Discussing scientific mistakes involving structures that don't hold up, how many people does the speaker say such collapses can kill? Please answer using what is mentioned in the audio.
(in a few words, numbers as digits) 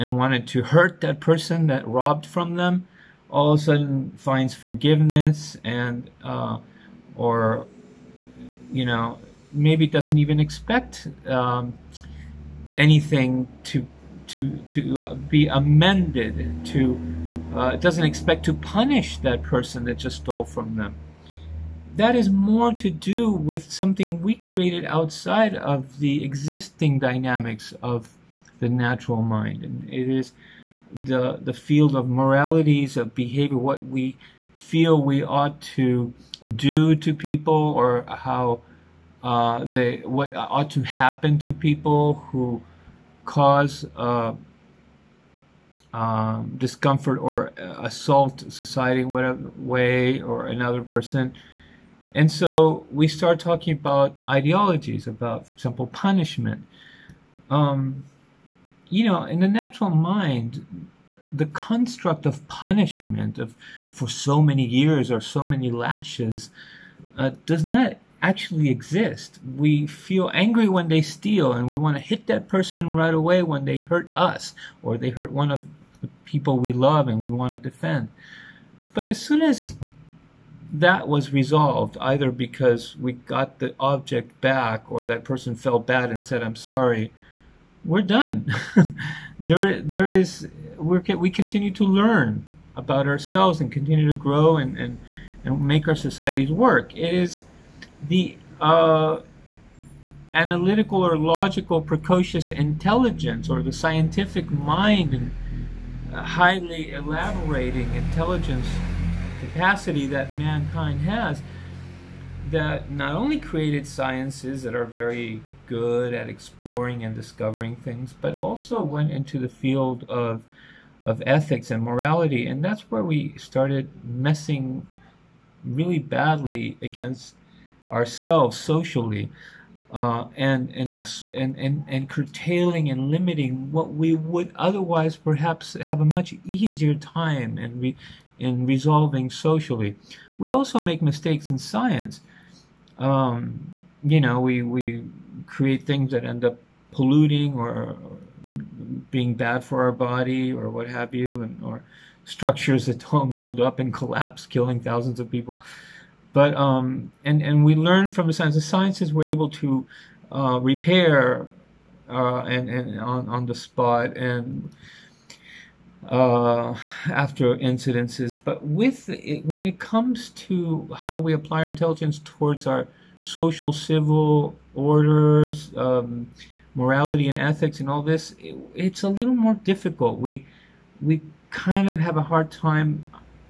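thousands.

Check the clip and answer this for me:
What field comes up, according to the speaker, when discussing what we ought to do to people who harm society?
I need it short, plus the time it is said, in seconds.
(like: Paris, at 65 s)
moralities of behavior, at 32 s.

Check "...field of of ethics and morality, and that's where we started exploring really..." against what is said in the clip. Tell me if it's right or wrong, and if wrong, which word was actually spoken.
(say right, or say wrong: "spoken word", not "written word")
wrong: "messing", not "exploring".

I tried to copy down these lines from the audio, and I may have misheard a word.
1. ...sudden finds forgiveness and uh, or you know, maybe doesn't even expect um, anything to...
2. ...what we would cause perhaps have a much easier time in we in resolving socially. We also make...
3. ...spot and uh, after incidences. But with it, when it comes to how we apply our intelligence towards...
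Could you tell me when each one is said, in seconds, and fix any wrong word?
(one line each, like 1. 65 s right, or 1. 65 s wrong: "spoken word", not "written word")
1. 3 s right
2. 133 s wrong: "otherwise", not "cause"
3. 163 s right.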